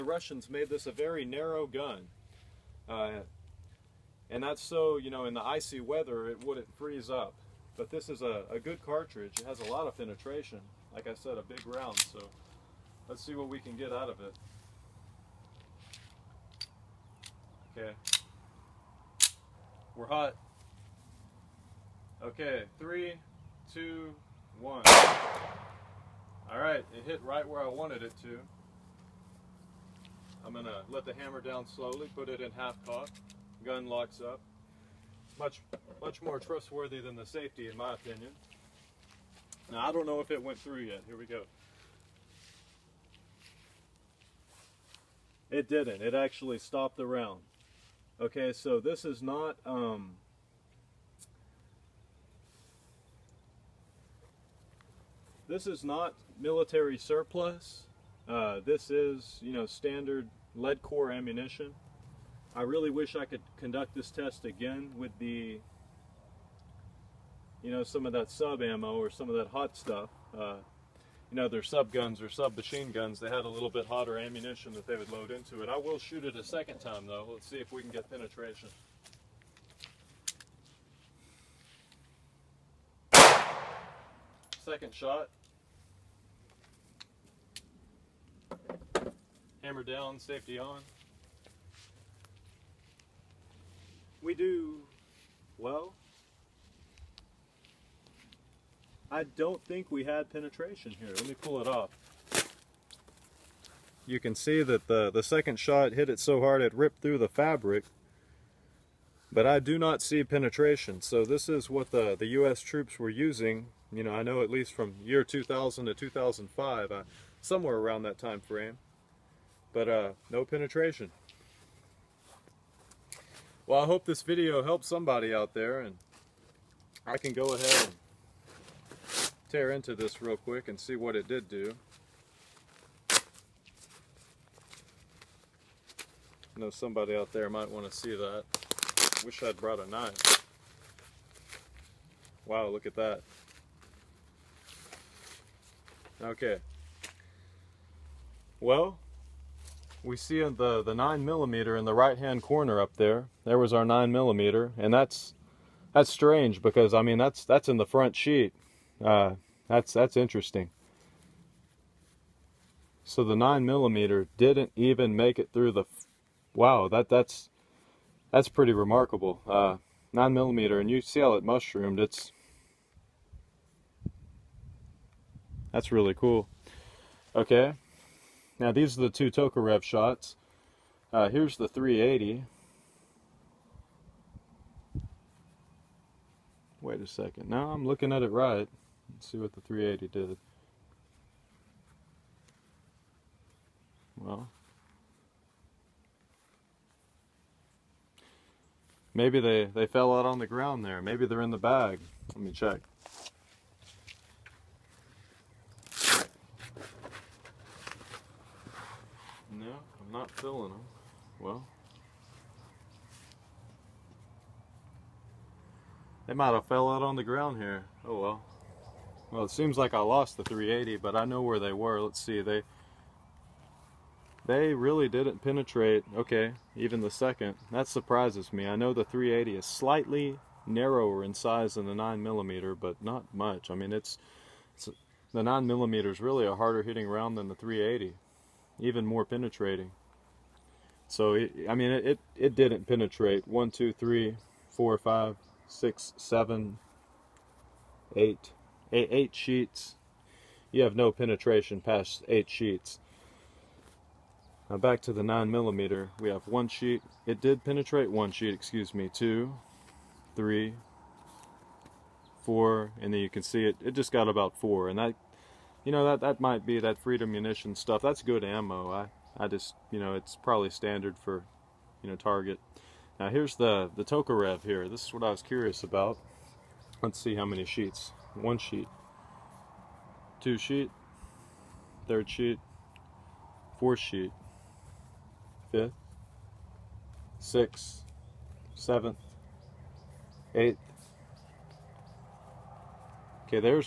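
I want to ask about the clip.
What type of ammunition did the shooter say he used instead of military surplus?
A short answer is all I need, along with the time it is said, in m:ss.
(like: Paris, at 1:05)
Standard lead core, at 1:00.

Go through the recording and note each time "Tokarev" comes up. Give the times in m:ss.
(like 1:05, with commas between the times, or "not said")
2:59, 4:34.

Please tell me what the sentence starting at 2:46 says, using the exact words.
Wow, that that's that's pretty remarkable.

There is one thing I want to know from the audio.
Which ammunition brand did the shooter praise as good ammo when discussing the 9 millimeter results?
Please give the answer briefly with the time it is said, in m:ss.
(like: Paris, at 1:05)
Freedom Munition, at 4:26.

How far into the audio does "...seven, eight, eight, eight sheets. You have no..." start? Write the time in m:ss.
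4:06.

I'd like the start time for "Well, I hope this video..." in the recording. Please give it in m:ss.
2:03.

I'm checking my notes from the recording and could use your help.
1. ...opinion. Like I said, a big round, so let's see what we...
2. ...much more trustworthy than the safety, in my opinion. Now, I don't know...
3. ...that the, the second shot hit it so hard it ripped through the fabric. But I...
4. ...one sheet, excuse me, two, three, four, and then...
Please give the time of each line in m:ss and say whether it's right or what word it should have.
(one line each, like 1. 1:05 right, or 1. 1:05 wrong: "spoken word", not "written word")
1. 0:09 wrong: "penetration", not "opinion"
2. 0:36 right
3. 1:44 right
4. 4:18 right.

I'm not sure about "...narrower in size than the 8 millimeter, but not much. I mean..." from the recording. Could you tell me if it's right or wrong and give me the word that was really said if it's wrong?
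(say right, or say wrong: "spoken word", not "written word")
wrong: "9", not "8".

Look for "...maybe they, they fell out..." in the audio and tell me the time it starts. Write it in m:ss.
3:19.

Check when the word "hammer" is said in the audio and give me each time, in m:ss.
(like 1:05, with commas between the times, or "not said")
0:31, 1:29.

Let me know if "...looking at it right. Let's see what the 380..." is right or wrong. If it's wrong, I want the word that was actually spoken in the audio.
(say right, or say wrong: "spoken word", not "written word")
right.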